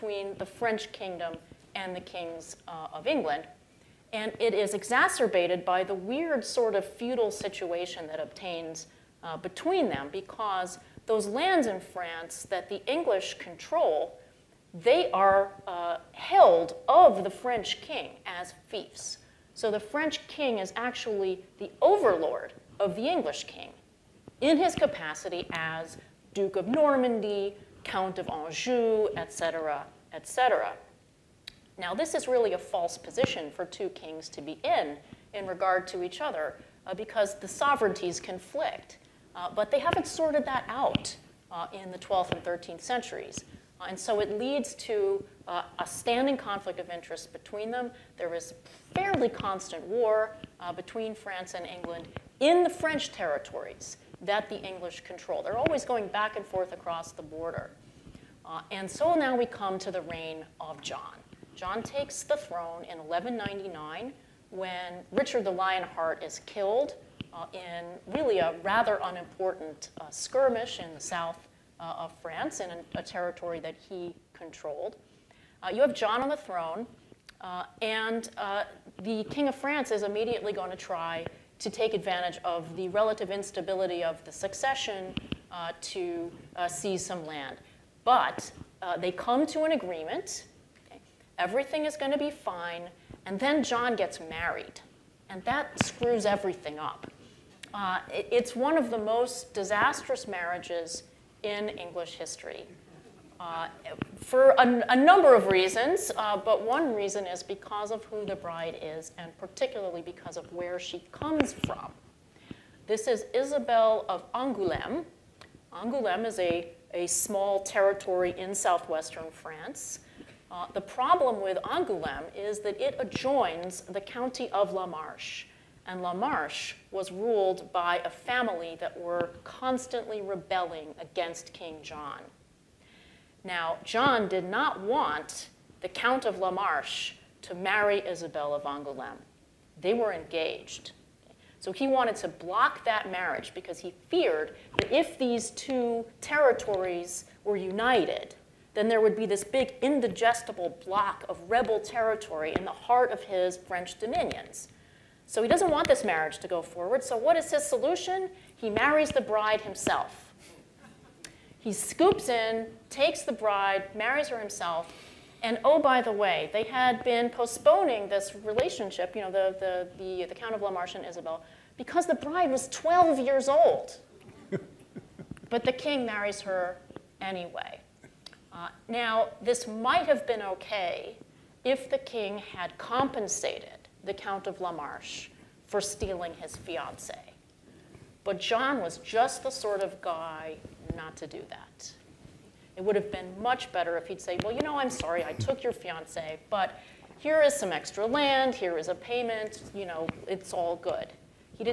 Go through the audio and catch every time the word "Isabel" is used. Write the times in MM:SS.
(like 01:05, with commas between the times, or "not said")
01:53, 02:18, 02:51.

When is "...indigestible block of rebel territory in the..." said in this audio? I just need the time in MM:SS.
02:29.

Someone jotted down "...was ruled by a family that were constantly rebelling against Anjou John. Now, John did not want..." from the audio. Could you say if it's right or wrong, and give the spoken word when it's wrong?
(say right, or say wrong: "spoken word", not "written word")
wrong: "King", not "Anjou".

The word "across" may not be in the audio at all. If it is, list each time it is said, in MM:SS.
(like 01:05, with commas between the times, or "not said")
00:56.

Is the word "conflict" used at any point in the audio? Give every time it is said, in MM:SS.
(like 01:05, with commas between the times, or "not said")
00:38, 00:46.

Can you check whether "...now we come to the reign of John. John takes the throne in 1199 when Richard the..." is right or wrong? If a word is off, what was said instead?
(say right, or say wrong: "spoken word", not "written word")
right.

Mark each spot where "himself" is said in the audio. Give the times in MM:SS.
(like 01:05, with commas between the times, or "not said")
02:39, 02:44.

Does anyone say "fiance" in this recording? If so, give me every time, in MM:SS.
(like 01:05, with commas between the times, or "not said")
03:06, 03:15.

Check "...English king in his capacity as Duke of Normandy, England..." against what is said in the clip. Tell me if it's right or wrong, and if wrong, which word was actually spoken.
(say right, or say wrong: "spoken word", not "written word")
wrong: "Count", not "England".